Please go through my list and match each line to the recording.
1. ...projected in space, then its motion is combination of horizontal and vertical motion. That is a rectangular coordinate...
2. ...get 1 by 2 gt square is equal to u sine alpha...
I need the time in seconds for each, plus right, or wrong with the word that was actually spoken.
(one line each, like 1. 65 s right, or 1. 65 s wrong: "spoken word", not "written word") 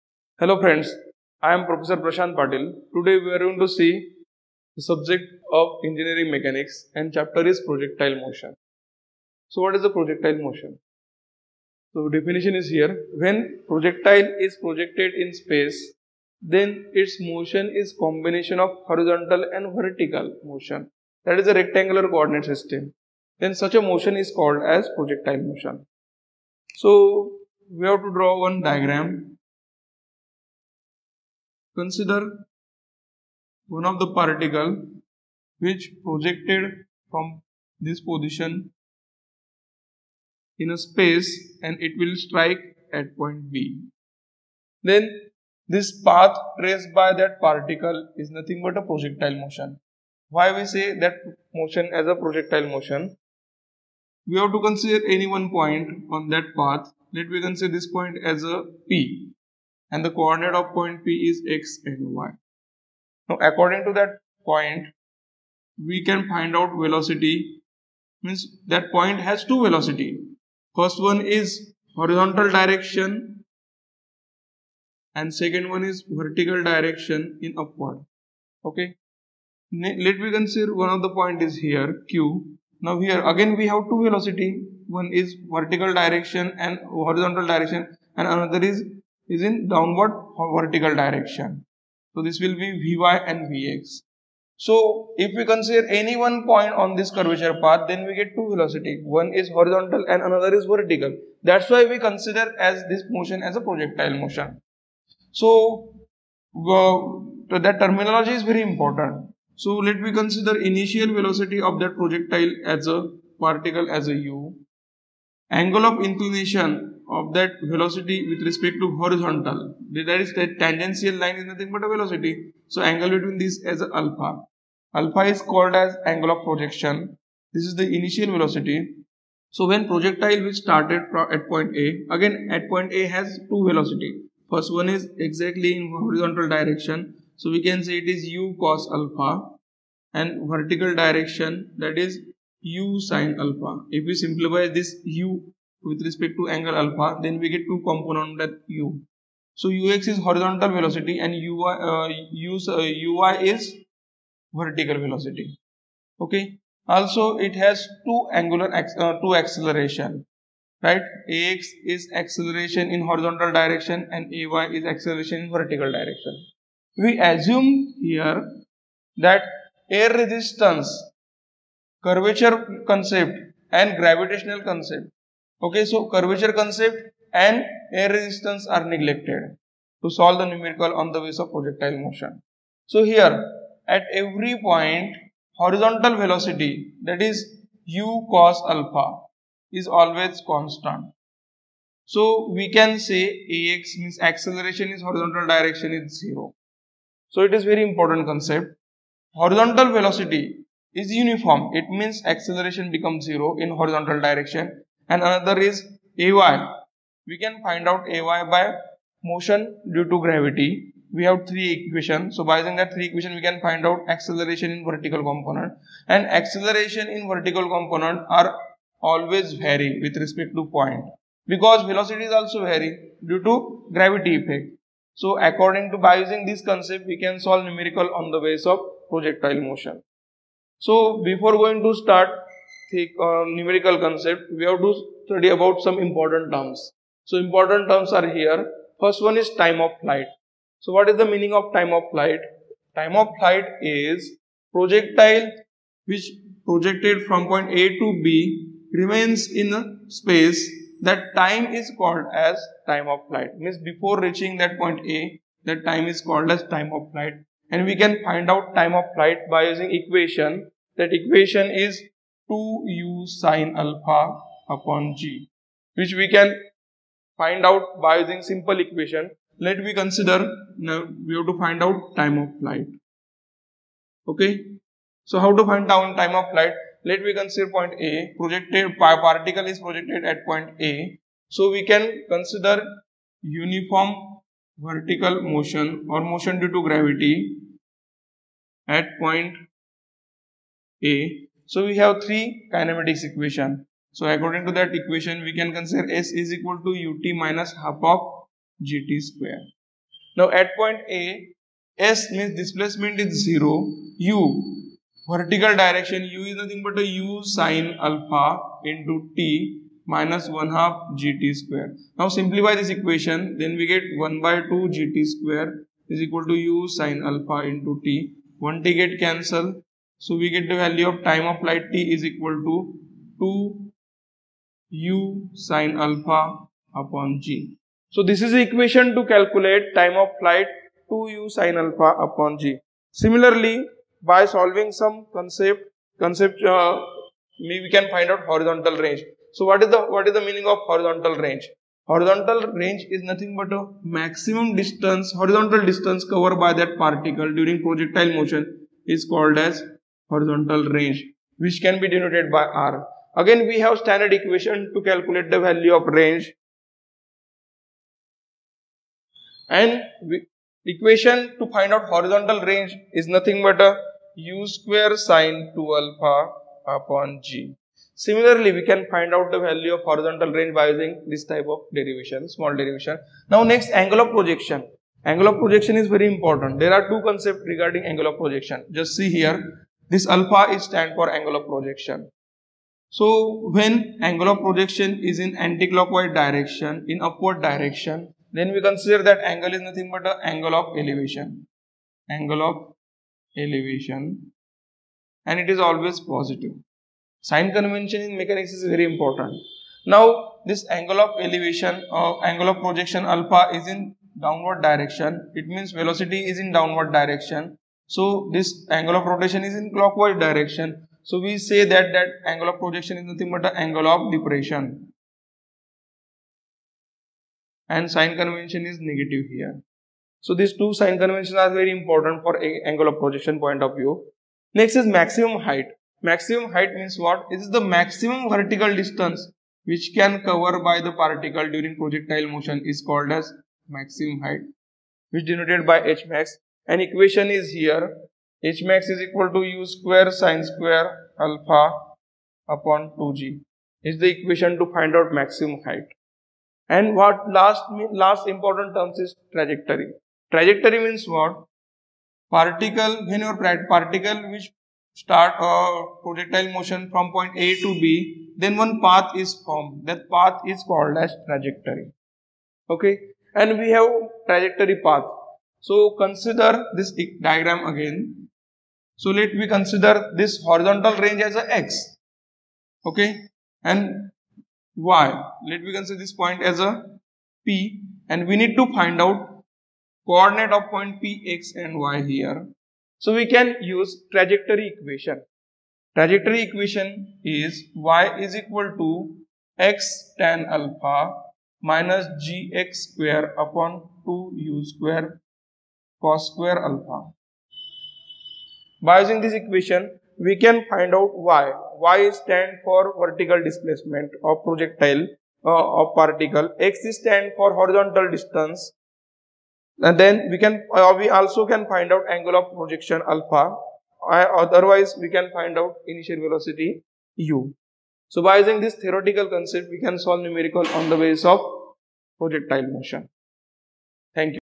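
1. 14 s right
2. 313 s right.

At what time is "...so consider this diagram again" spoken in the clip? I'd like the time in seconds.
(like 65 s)
465 s.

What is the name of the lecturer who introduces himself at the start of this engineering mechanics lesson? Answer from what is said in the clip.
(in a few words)
Prashant Patil.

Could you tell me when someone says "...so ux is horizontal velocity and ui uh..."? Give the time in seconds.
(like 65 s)
149 s.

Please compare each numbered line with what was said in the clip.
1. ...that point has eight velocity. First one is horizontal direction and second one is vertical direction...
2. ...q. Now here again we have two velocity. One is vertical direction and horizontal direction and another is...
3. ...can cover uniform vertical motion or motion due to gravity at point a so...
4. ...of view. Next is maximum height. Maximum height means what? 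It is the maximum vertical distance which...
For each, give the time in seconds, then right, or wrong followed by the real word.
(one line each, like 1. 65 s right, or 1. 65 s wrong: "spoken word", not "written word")
1. 68 s wrong: "two", not "eight"
2. 82 s right
3. 281 s wrong: "consider", not "cover"
4. 423 s right.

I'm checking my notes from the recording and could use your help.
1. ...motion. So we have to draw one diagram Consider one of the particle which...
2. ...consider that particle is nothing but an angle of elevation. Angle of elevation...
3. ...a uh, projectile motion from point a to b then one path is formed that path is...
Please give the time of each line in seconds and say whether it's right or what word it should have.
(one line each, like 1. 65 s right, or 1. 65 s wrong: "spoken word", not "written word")
1. 25 s right
2. 388 s wrong: "angle", not "particle"
3. 455 s right.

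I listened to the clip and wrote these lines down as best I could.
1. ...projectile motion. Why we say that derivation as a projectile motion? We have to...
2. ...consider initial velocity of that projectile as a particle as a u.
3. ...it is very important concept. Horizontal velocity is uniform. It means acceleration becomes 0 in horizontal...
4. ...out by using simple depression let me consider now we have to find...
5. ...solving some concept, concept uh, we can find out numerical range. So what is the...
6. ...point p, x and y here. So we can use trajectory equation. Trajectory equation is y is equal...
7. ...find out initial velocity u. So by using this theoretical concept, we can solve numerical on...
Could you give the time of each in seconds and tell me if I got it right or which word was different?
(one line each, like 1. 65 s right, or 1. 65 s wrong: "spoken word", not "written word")
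1. 48 s wrong: "motion", not "derivation"
2. 110 s right
3. 197 s right
4. 267 s wrong: "equation", not "depression"
5. 334 s wrong: "horizontal", not "numerical"
6. 480 s right
7. 515 s right.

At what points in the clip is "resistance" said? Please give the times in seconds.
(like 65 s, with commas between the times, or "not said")
170 s, 178 s.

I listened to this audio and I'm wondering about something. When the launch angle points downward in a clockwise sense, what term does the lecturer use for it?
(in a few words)
angle of depression.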